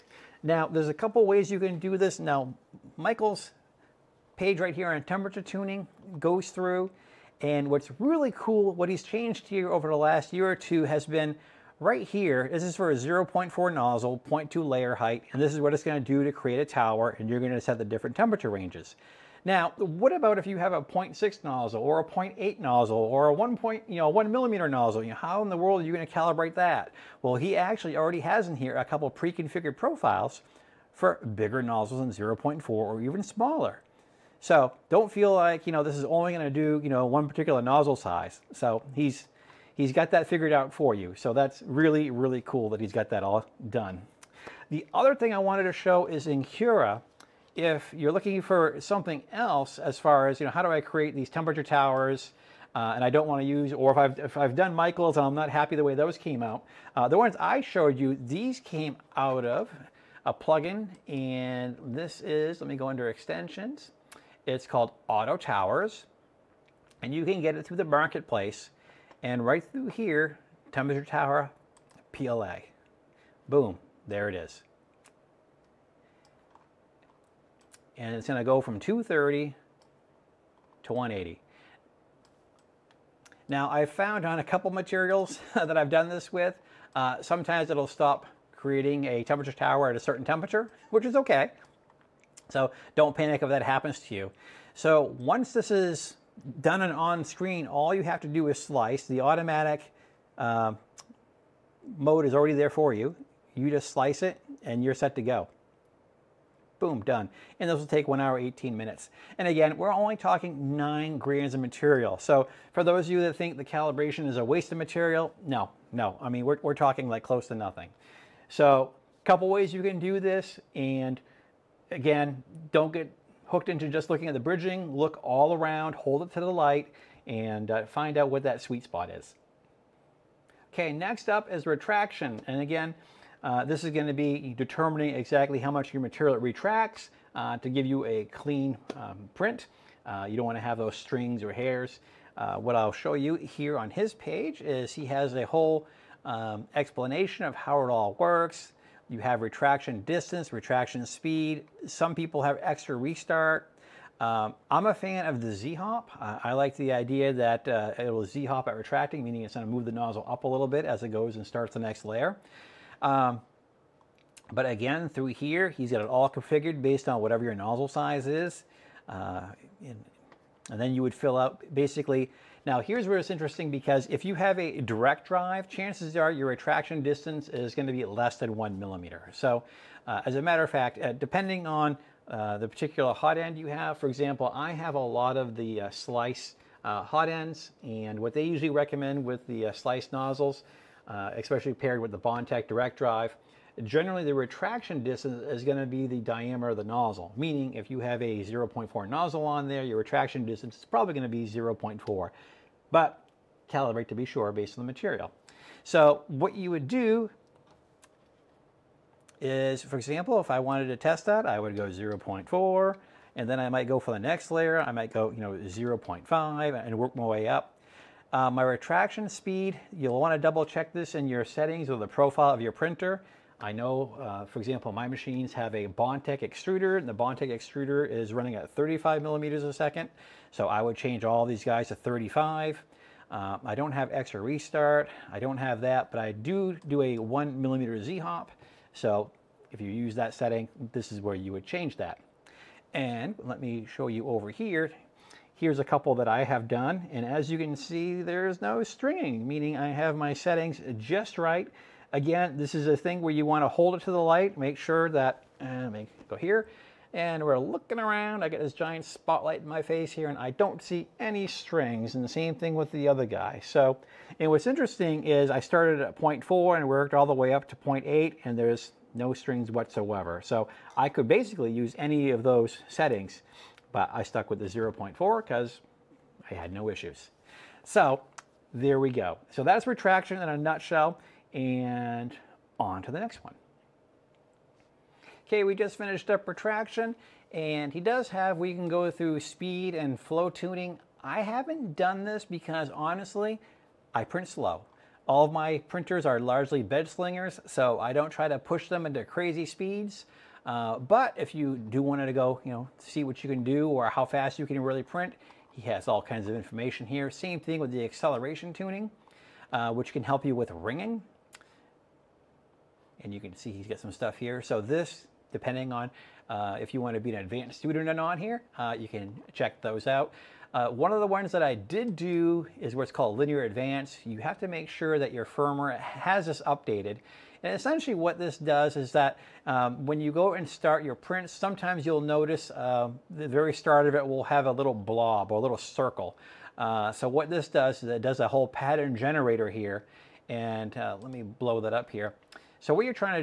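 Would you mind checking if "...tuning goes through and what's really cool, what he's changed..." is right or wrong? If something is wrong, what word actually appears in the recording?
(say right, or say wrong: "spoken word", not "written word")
right.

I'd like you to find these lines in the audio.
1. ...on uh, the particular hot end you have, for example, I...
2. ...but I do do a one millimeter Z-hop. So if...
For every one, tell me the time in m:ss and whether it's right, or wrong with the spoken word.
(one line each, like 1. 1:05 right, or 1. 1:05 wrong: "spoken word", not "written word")
1. 3:01 right
2. 3:56 right.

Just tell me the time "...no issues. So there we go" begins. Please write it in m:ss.
4:36.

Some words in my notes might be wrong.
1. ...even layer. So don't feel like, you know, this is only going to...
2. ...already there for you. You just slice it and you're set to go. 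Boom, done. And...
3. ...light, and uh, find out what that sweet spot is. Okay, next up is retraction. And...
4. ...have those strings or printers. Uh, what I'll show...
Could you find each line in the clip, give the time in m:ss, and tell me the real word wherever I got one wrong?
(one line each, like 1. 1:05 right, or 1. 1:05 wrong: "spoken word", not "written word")
1. 0:32 wrong: "smaller", not "layer"
2. 1:42 right
3. 2:06 right
4. 2:20 wrong: "hairs", not "printers".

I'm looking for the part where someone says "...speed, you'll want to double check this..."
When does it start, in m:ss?
3:39.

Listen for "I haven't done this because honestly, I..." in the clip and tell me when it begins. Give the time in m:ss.
4:51.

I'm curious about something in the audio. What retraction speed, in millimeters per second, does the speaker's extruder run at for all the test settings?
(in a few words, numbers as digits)
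35.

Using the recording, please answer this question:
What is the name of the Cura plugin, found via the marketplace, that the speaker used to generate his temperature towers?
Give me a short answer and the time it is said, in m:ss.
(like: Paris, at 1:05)
Auto Towers, at 1:05.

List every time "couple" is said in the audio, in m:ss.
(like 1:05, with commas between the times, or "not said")
0:00, 0:28, 1:24, 1:59, 4:05.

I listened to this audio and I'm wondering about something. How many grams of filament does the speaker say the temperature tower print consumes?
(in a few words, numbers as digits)
9.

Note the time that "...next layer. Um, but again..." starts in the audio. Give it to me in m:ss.
2:41.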